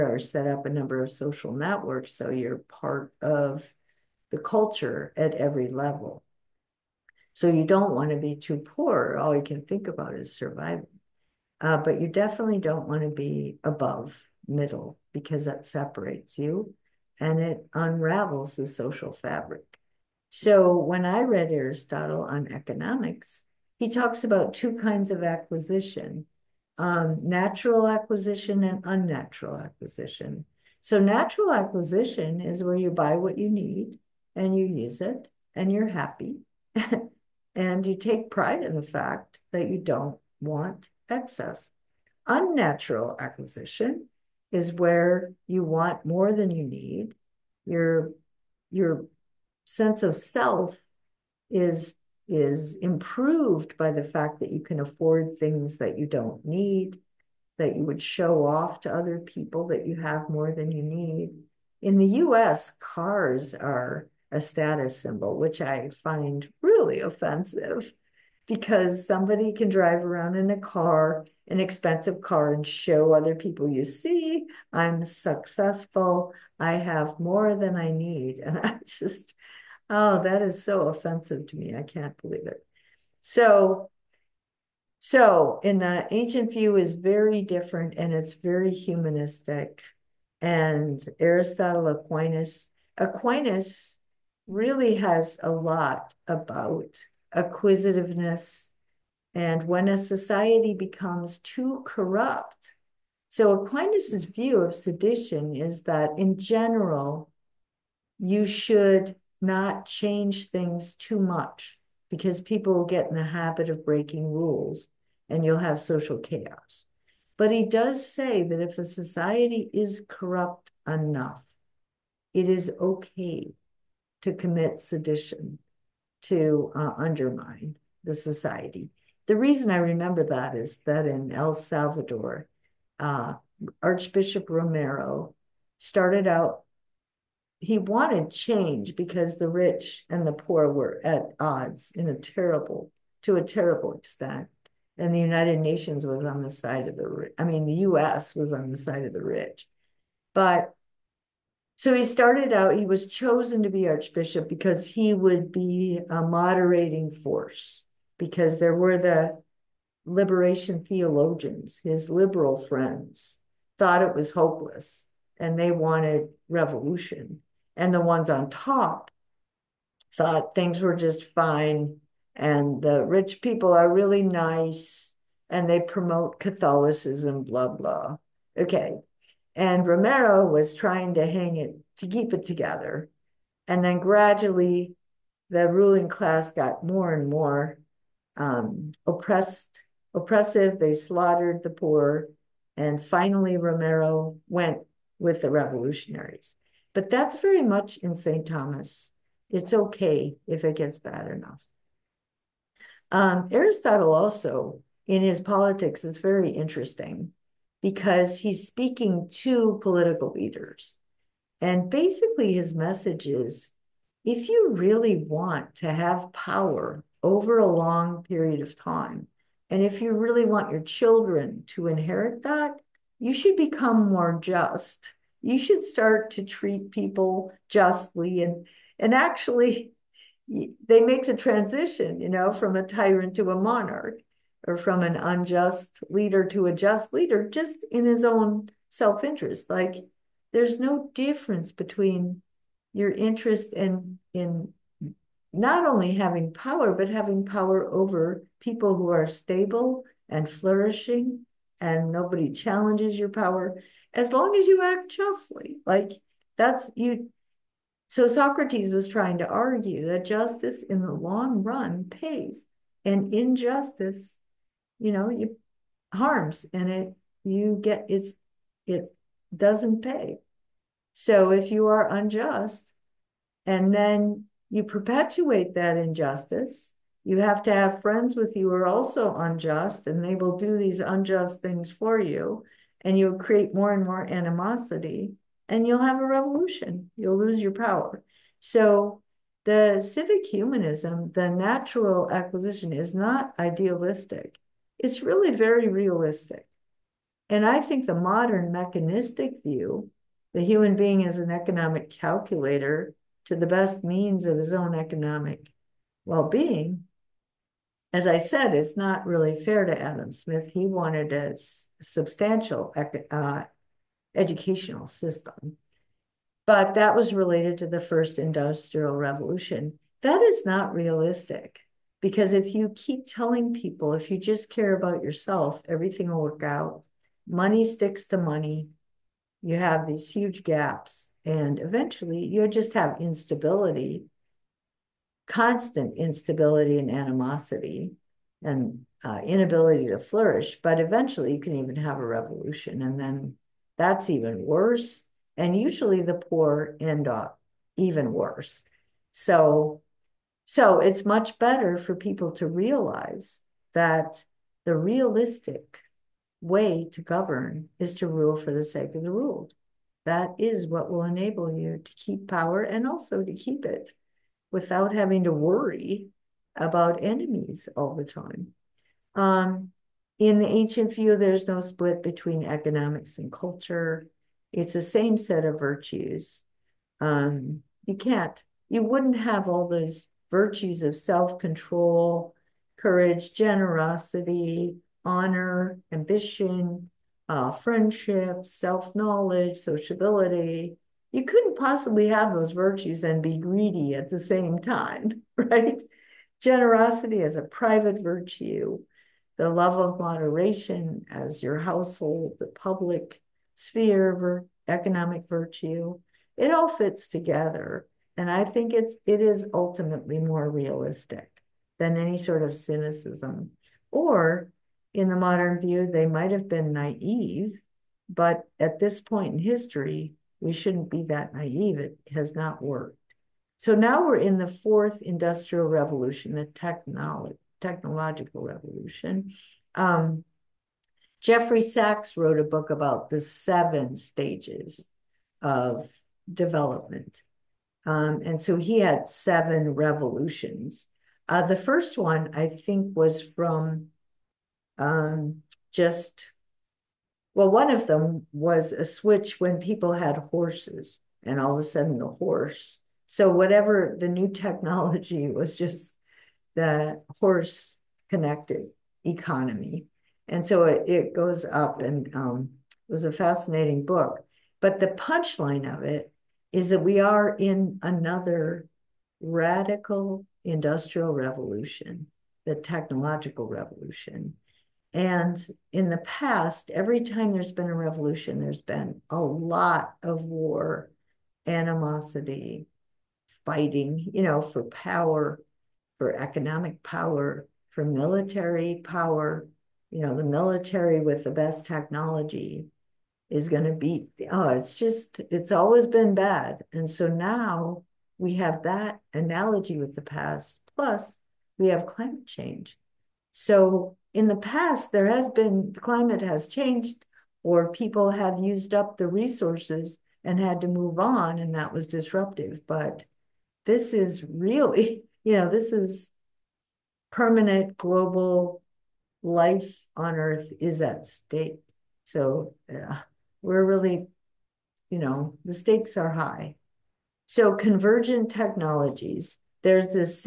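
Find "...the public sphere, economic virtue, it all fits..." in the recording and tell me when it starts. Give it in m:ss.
6:42.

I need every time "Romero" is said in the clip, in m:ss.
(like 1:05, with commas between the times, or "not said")
2:14, 2:59, 3:13.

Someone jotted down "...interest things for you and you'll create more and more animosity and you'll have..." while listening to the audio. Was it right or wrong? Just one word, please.
wrong.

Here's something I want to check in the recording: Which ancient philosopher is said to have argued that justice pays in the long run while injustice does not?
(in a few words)
Socrates.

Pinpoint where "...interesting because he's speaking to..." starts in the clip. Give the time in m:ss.
3:26.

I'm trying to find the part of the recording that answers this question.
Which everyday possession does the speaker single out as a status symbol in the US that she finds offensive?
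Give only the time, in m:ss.
1:02.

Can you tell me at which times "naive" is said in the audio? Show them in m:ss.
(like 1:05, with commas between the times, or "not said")
6:56, 7:01.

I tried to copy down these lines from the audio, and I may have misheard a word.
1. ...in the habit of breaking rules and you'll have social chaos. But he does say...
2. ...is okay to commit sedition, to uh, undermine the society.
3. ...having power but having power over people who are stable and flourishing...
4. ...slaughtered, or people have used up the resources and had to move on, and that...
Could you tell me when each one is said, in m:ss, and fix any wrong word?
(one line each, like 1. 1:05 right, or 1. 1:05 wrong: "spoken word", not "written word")
1. 1:53 right
2. 2:02 right
3. 4:06 right
4. 8:26 wrong: "changed", not "slaughtered".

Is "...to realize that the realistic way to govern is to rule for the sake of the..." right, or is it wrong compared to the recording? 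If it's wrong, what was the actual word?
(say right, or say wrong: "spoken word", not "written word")
right.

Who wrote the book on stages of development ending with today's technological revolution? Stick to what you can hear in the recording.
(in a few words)
Jeffrey Sachs.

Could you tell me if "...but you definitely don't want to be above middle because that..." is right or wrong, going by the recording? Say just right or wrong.
right.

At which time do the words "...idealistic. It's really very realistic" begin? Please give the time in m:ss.
4:53.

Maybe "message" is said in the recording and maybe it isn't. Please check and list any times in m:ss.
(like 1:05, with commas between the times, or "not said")
3:32.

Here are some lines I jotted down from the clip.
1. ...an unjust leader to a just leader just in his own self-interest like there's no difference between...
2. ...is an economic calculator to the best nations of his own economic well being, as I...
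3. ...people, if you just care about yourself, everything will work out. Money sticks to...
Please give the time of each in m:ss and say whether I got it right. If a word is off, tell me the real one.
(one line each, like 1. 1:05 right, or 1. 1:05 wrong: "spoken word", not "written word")
1. 3:55 right
2. 5:01 wrong: "means", not "nations"
3. 5:23 right.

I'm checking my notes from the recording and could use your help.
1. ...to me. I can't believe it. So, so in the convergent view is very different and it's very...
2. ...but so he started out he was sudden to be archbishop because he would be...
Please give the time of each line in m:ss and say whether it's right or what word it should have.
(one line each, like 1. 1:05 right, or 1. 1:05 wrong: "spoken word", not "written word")
1. 1:21 wrong: "ancient", not "convergent"
2. 2:30 wrong: "chosen", not "sudden".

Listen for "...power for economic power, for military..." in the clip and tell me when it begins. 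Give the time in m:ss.
8:04.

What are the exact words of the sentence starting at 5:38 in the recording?
And uh, inability to flourish, but eventually you can even have a revolution.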